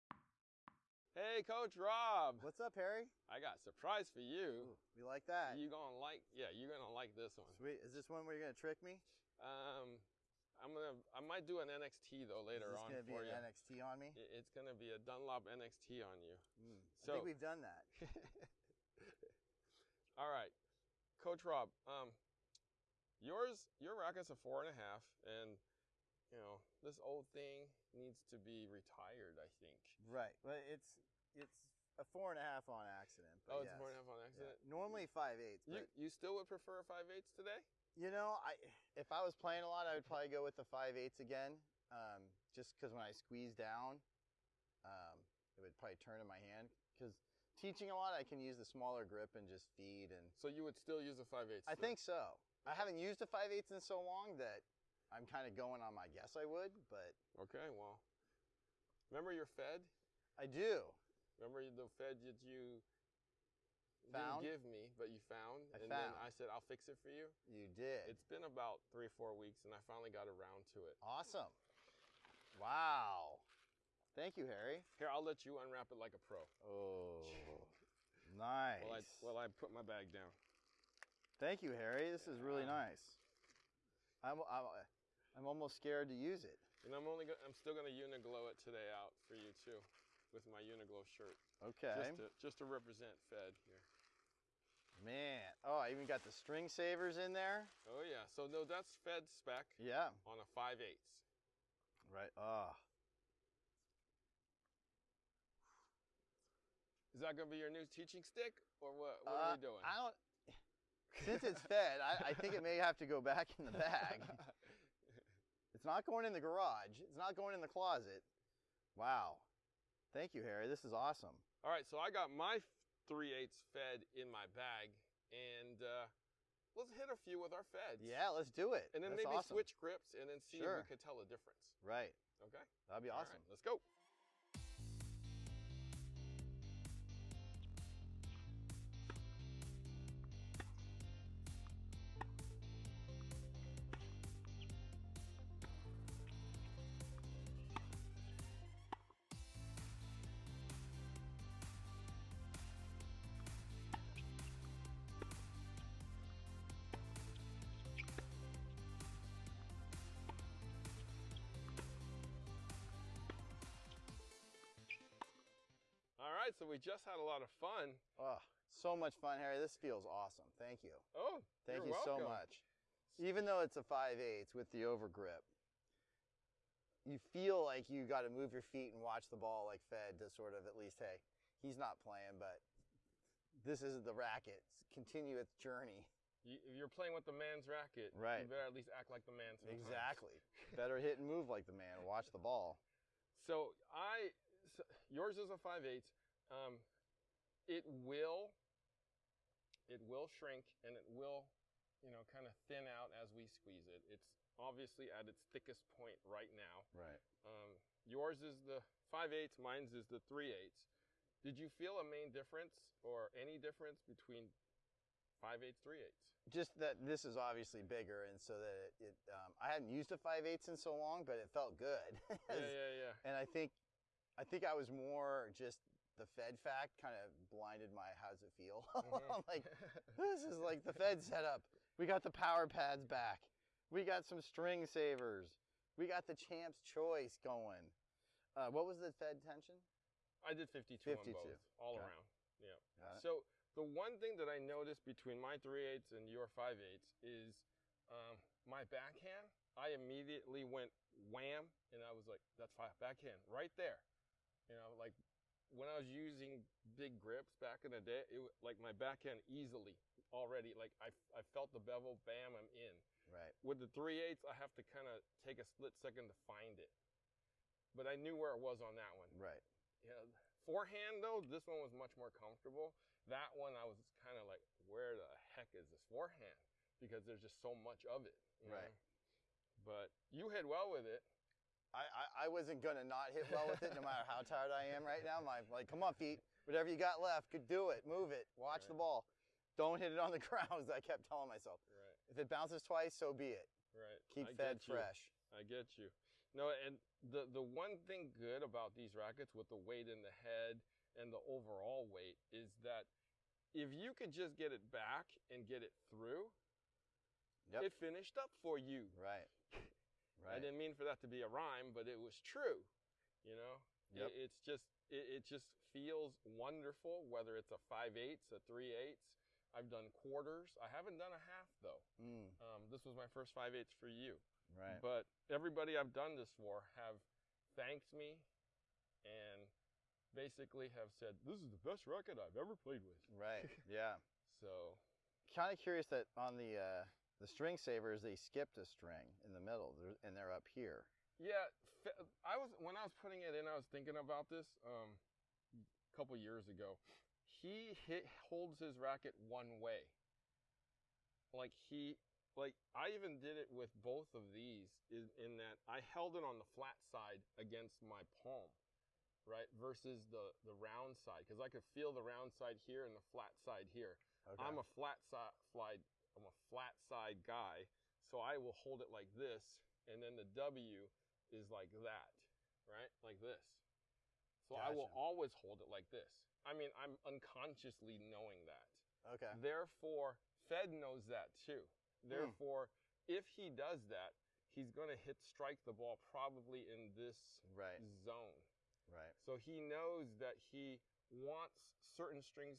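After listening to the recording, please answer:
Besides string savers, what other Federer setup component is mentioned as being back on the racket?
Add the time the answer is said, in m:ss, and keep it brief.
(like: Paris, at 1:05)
power pads, at 3:52.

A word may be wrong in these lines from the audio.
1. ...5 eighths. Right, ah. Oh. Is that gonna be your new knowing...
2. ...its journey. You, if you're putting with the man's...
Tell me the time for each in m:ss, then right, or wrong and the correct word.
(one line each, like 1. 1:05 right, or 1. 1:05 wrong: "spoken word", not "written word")
1. 1:40 wrong: "teaching", not "knowing"
2. 3:05 wrong: "playing", not "putting".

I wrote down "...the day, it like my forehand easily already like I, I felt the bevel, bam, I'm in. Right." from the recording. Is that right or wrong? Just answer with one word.
wrong.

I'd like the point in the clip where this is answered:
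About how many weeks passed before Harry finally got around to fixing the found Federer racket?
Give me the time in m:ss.
1:08.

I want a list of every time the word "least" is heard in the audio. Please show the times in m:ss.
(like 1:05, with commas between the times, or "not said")
3:00, 3:08.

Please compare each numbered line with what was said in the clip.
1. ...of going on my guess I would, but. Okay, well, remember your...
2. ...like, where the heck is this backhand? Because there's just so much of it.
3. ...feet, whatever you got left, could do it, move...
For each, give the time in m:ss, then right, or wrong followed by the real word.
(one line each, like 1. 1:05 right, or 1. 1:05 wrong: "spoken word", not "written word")
1. 0:55 right
2. 4:34 wrong: "forehand", not "backhand"
3. 4:46 right.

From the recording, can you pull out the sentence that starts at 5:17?
Whether it's a five eighths, a three eighths, I've done quarters.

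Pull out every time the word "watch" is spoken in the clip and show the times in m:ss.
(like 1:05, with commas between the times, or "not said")
2:59, 3:12, 4:48.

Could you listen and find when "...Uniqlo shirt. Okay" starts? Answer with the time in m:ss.
1:30.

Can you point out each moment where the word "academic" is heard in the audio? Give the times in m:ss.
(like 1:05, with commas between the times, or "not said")
not said.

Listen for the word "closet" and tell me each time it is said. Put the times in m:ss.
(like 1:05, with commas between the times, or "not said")
1:57.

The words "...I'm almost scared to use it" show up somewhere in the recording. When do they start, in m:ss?
1:25.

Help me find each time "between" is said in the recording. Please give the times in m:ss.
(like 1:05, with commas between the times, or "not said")
3:34, 4:05.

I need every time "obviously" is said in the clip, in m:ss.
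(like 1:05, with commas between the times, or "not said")
3:24, 3:37.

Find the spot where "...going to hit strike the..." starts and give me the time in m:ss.
6:24.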